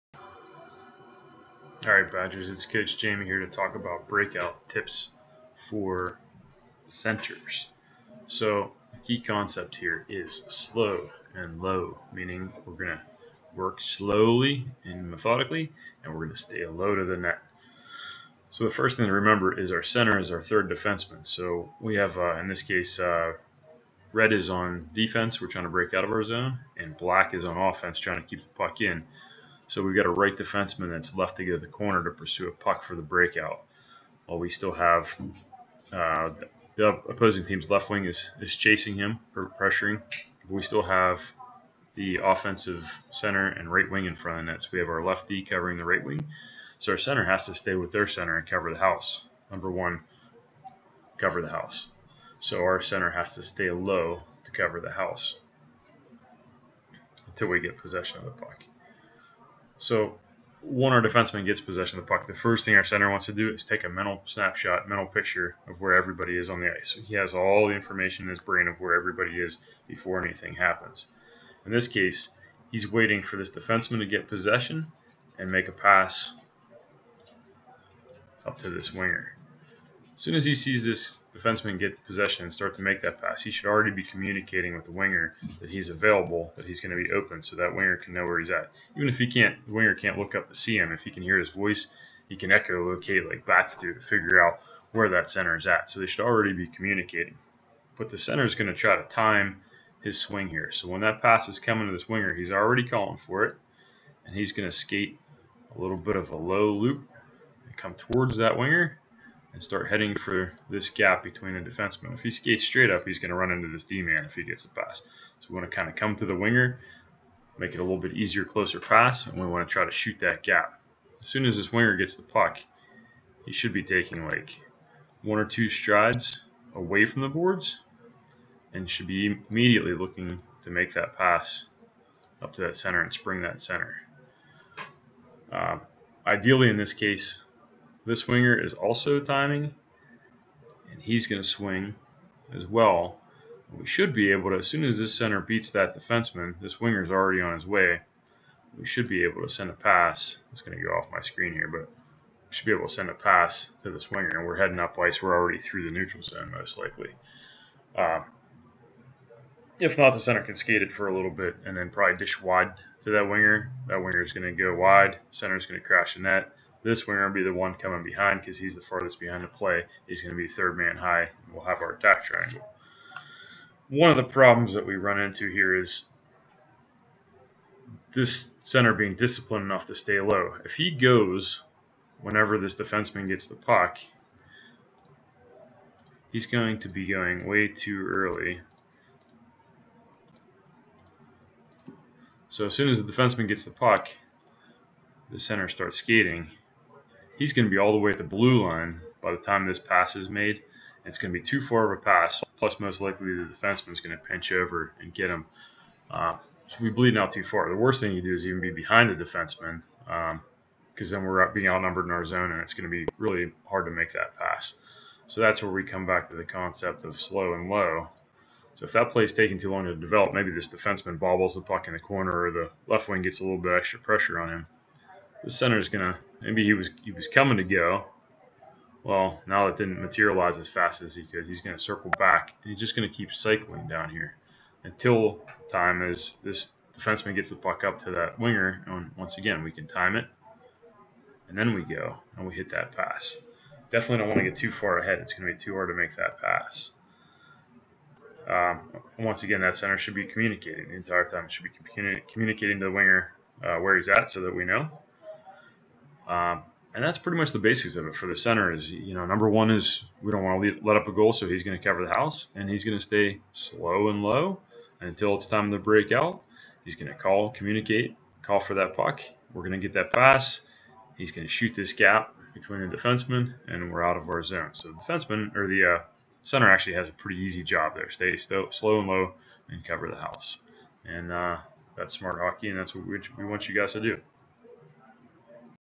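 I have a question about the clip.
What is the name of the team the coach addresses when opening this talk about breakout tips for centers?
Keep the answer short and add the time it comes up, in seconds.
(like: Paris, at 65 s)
Badgers, at 2 s.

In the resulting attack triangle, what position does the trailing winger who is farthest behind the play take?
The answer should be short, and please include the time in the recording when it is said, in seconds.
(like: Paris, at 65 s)
third man high, at 170 s.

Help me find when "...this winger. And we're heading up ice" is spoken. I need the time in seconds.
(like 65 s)
153 s.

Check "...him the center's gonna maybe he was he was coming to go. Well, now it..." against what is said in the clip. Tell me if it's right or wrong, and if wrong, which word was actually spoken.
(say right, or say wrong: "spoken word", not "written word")
right.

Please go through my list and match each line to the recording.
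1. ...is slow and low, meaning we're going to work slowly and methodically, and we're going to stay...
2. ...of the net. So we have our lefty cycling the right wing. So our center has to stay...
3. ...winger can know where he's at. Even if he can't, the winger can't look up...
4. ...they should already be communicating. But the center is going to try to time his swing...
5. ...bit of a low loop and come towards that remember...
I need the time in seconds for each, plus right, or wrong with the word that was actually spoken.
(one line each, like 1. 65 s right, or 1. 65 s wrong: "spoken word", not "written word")
1. 10 s right
2. 44 s wrong: "covering", not "cycling"
3. 87 s right
4. 95 s right
5. 105 s wrong: "winger", not "remember".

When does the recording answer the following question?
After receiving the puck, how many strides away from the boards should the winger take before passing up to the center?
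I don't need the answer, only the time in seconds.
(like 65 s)
125 s.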